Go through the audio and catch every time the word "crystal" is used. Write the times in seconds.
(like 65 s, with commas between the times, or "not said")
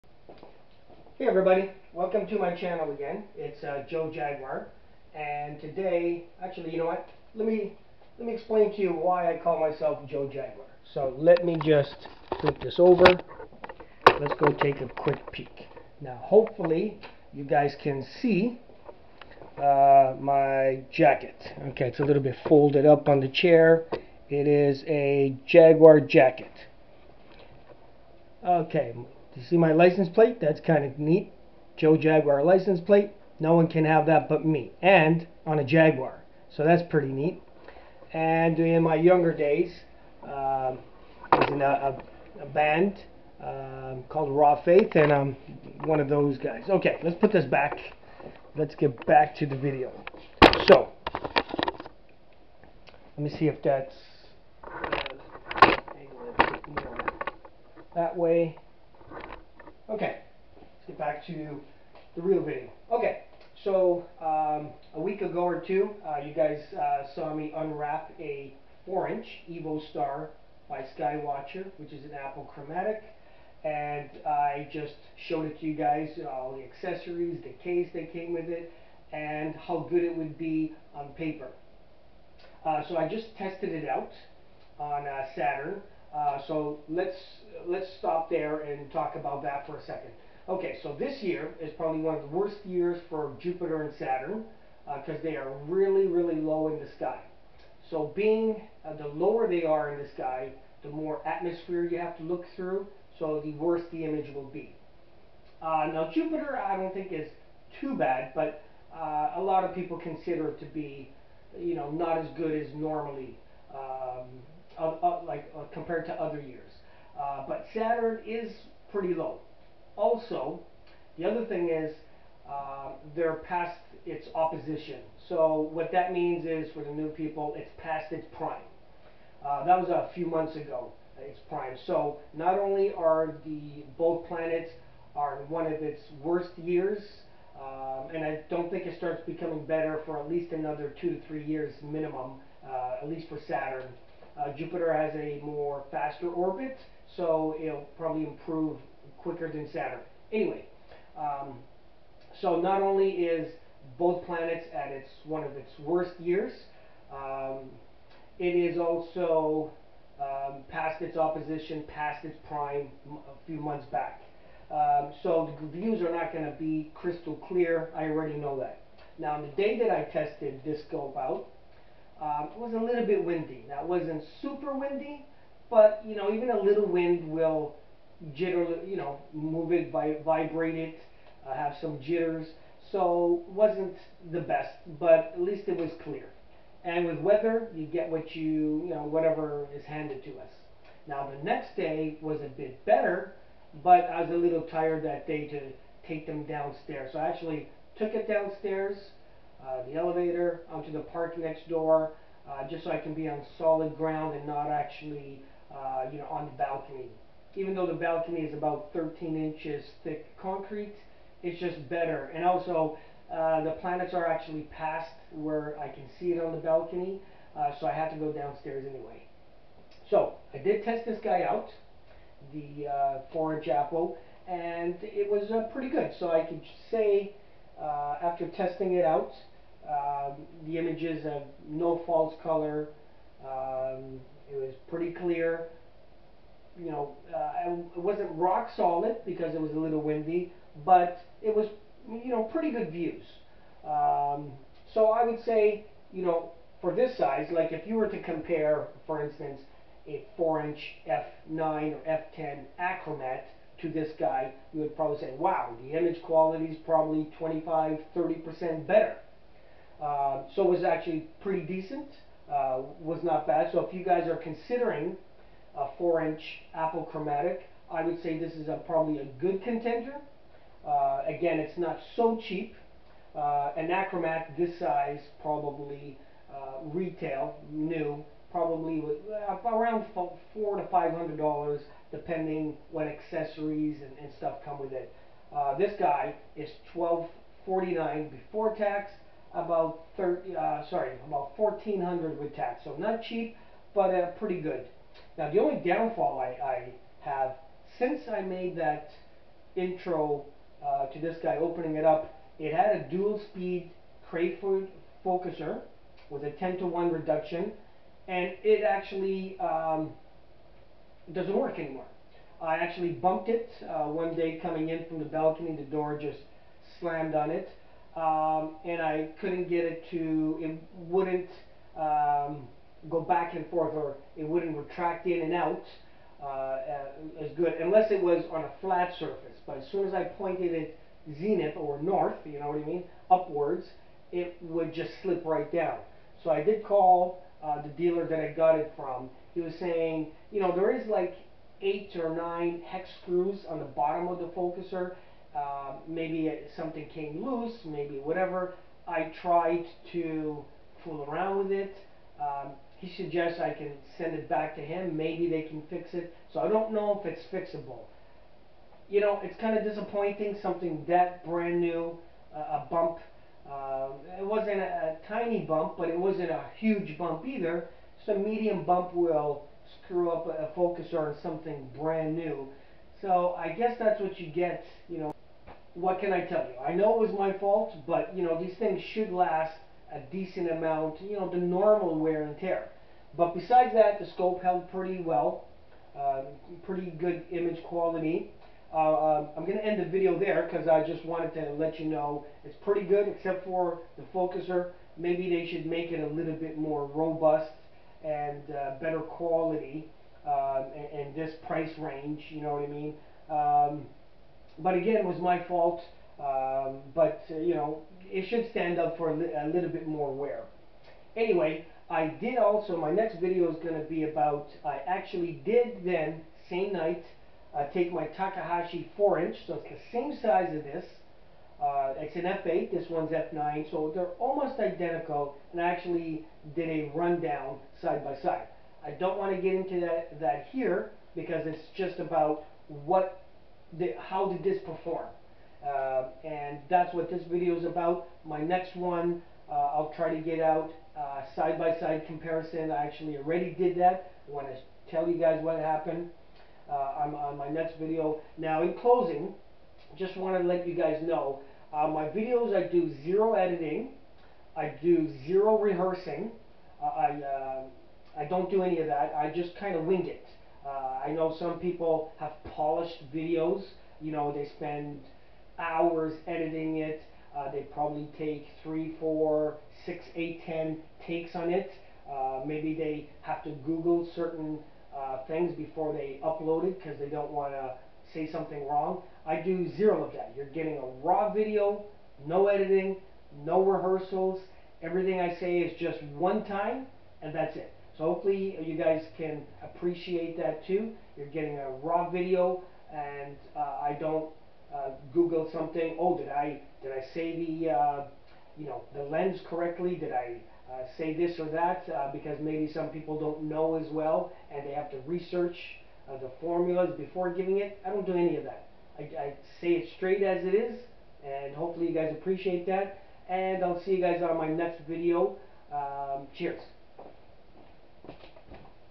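166 s.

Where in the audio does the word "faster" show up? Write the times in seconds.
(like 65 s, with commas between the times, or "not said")
145 s.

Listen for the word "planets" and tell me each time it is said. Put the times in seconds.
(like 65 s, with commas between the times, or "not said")
134 s, 154 s, 213 s.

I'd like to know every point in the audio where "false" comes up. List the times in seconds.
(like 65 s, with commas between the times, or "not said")
232 s.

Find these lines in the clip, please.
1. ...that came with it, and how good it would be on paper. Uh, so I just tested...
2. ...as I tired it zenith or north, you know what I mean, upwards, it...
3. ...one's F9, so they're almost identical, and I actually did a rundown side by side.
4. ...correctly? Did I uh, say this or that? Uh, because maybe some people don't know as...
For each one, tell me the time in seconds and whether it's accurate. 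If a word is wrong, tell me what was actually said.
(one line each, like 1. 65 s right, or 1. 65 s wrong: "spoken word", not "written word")
1. 77 s right
2. 330 s wrong: "pointed", not "tired"
3. 423 s right
4. 499 s right.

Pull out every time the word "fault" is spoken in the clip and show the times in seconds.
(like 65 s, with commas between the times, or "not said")
377 s, 405 s.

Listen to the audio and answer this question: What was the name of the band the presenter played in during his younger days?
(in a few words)
Raw Faith.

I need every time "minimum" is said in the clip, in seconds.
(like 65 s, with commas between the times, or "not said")
141 s.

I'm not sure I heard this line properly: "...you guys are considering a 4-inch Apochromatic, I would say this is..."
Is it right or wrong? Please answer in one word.
right.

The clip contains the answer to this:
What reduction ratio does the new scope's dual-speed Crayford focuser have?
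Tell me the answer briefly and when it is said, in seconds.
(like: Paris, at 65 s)
10 to 1, at 306 s.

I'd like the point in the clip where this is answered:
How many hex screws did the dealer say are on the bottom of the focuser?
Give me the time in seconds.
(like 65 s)
341 s.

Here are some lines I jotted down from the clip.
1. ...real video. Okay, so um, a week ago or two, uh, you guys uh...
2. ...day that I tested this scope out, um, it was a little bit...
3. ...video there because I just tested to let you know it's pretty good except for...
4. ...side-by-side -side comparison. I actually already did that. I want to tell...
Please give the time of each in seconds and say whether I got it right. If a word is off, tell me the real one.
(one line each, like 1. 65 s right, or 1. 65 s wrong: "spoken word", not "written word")
1. 62 s right
2. 169 s right
3. 390 s wrong: "wanted", not "tested"
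4. 441 s right.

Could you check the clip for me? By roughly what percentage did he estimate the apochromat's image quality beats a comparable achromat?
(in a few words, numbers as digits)
25-30%.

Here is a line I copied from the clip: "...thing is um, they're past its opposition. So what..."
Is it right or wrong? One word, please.
right.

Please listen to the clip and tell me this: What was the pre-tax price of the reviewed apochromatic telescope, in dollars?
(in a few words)
1249.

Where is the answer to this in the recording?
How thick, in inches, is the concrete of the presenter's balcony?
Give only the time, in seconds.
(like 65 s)
208 s.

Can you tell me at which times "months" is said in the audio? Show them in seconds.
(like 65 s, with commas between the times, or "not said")
130 s, 163 s.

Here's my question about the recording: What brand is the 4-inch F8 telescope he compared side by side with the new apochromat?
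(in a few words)
Takahashi.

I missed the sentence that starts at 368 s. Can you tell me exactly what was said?
So a medium bump will screw up a, a focuser on something brand new.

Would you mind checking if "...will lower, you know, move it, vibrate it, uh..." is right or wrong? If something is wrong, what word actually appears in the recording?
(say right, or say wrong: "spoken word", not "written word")
wrong: "jitter", not "lower".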